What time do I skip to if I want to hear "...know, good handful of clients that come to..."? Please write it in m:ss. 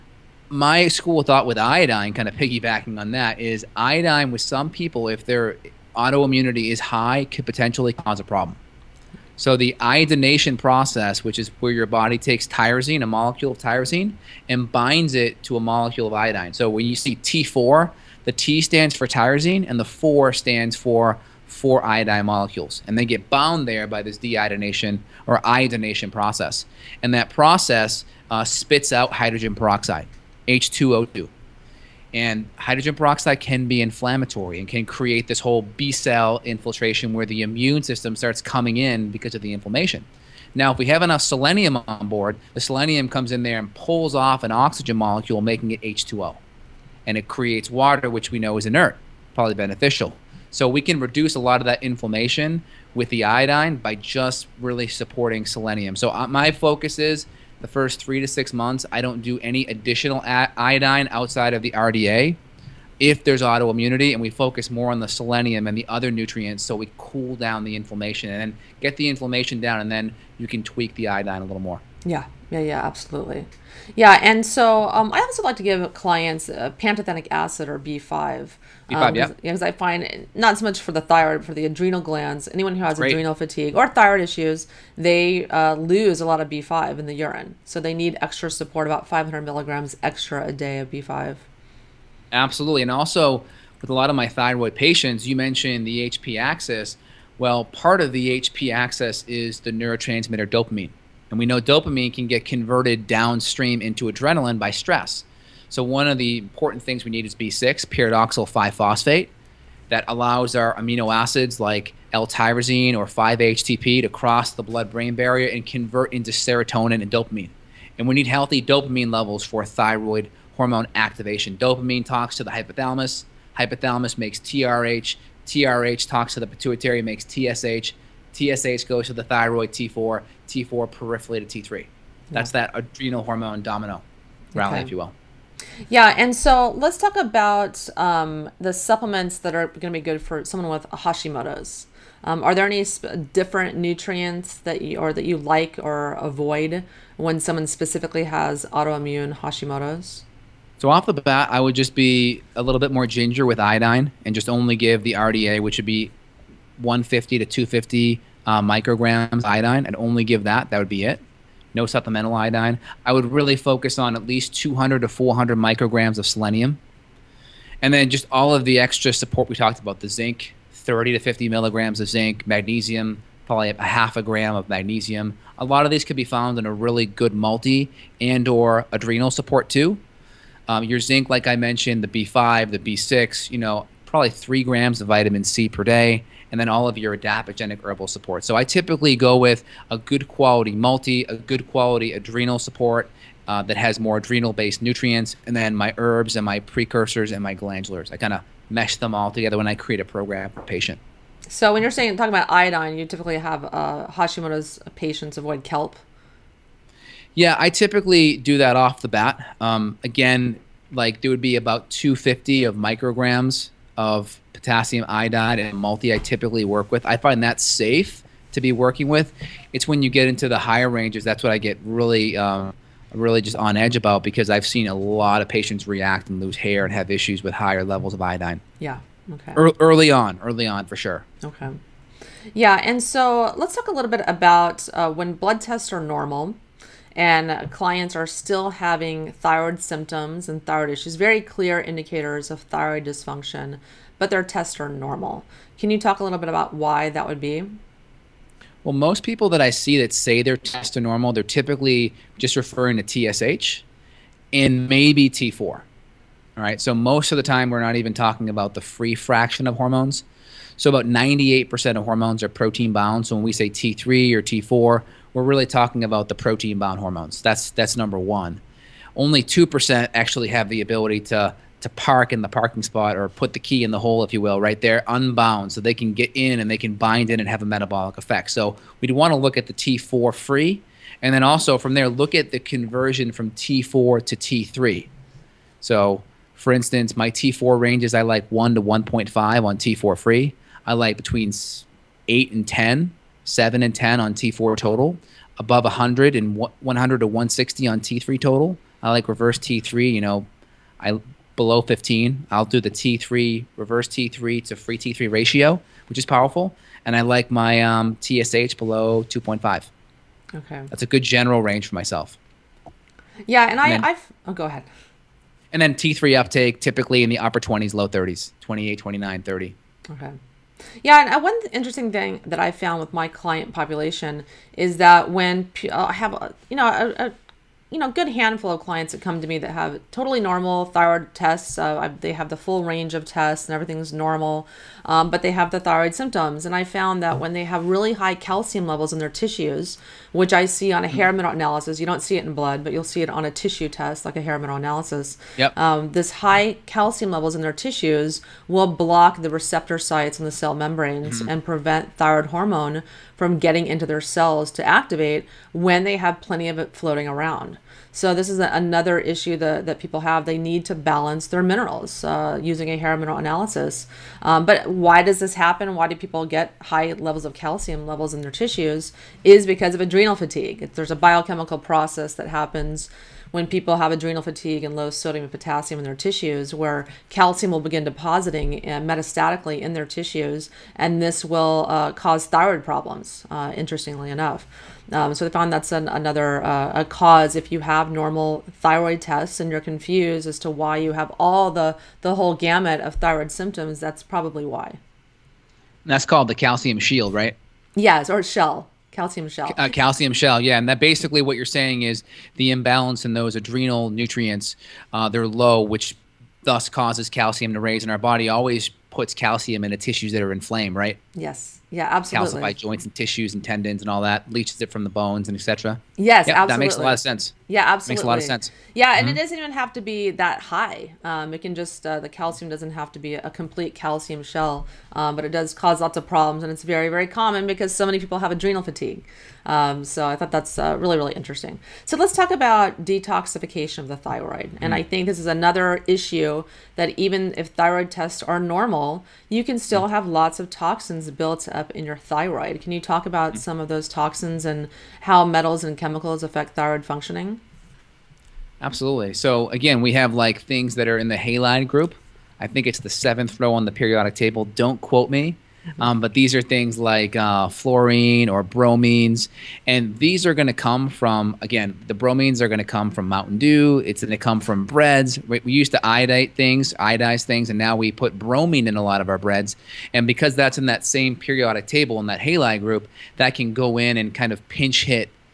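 5:27.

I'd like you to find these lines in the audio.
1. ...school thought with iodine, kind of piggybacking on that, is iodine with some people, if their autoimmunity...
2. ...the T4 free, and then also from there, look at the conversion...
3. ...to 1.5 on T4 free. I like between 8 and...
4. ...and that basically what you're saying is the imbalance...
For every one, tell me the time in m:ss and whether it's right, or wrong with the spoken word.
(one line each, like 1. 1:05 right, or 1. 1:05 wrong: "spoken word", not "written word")
1. 0:00 right
2. 4:39 right
3. 4:48 right
4. 6:40 right.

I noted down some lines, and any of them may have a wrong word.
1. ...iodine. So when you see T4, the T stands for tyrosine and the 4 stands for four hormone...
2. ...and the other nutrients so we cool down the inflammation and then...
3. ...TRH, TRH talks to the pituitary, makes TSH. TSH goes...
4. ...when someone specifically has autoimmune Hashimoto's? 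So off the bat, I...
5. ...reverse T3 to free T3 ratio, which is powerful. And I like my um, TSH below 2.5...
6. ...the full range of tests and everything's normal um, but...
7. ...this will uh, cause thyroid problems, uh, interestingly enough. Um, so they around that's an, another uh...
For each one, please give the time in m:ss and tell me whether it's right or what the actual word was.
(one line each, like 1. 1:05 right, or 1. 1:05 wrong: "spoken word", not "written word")
1. 0:16 wrong: "iodine", not "hormone"
2. 1:05 right
3. 2:04 right
4. 2:27 right
5. 5:03 right
6. 5:32 right
7. 6:21 wrong: "found", not "around".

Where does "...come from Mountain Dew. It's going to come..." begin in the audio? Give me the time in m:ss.
7:42.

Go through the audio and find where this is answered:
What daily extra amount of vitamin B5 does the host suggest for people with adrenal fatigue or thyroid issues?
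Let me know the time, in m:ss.
1:29.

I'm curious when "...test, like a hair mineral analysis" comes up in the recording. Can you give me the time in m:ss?
5:43.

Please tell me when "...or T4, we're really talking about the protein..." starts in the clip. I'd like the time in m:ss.
4:24.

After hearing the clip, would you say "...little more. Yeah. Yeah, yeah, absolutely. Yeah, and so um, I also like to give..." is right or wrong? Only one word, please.
right.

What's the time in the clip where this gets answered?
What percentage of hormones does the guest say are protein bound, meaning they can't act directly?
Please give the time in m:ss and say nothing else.
4:21.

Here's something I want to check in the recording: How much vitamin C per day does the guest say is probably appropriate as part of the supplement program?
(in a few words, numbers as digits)
3 grams.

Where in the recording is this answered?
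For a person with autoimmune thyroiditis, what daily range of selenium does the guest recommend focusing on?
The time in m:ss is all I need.
2:44.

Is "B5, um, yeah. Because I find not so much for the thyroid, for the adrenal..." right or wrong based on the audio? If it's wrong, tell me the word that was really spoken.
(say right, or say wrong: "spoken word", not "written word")
right.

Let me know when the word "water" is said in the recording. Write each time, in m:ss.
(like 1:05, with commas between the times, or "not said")
0:47.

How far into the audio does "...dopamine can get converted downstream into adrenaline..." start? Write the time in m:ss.
1:41.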